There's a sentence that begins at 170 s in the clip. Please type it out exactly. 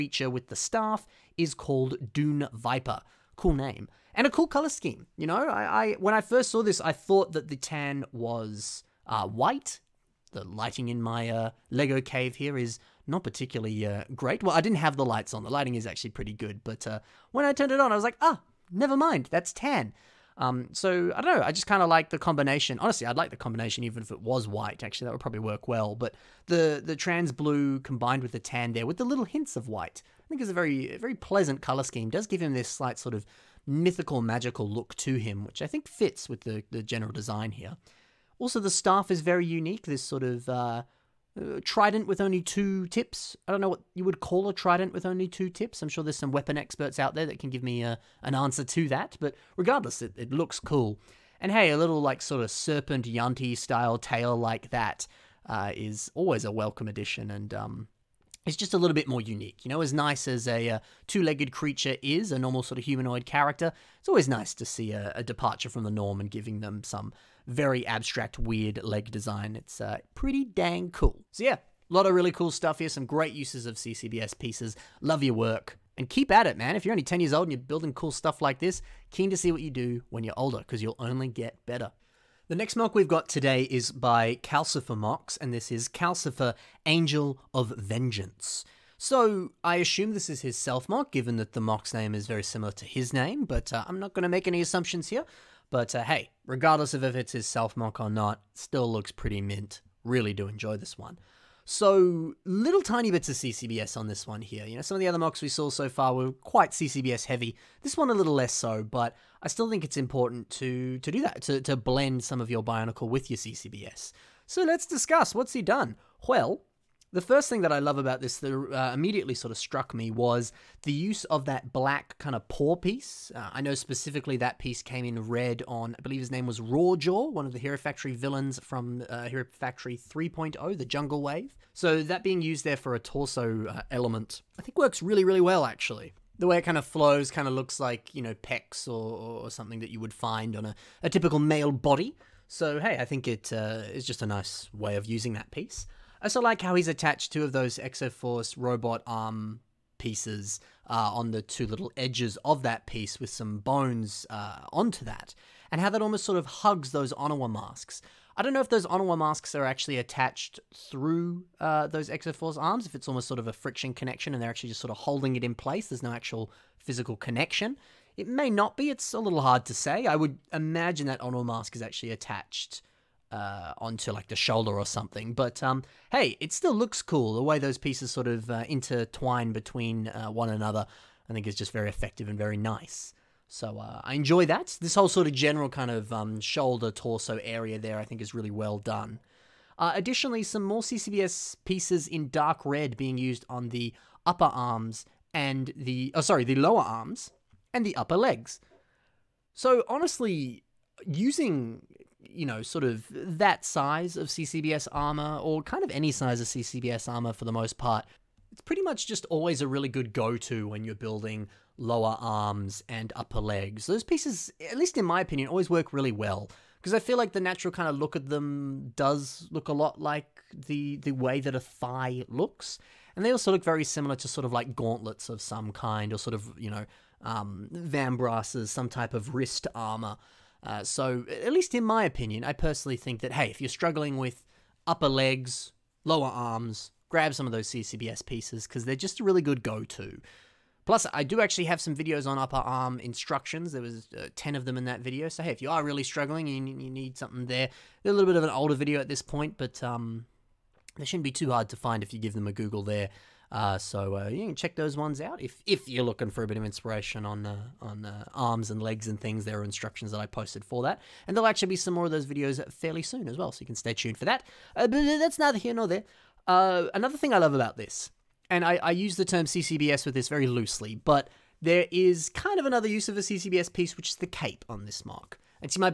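I would imagine that Onua mask is actually attached uh, onto like the shoulder or something.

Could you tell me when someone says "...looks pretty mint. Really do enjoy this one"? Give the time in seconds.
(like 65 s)
98 s.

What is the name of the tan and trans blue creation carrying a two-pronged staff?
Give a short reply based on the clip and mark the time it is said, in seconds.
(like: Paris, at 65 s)
Dune Viper, at 2 s.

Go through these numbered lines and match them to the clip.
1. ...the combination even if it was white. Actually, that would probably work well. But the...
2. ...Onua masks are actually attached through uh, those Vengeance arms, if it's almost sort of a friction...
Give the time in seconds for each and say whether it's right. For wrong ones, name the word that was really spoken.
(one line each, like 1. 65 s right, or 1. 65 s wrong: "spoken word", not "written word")
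1. 23 s right
2. 158 s wrong: "Exoforce", not "Vengeance".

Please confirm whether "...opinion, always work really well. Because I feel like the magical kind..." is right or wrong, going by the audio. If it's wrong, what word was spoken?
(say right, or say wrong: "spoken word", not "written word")
wrong: "natural", not "magical".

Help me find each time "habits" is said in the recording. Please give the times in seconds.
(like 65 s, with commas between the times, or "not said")
not said.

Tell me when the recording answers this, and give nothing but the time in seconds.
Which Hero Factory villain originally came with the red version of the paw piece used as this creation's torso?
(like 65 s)
126 s.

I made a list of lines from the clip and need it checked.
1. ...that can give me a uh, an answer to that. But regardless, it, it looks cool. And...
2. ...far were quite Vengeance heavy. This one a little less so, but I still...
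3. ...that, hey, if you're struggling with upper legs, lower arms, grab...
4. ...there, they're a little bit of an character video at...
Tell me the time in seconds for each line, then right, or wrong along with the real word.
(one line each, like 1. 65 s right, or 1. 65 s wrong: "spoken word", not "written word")
1. 47 s right
2. 105 s wrong: "CCBS", not "Vengeance"
3. 233 s right
4. 247 s wrong: "older", not "character".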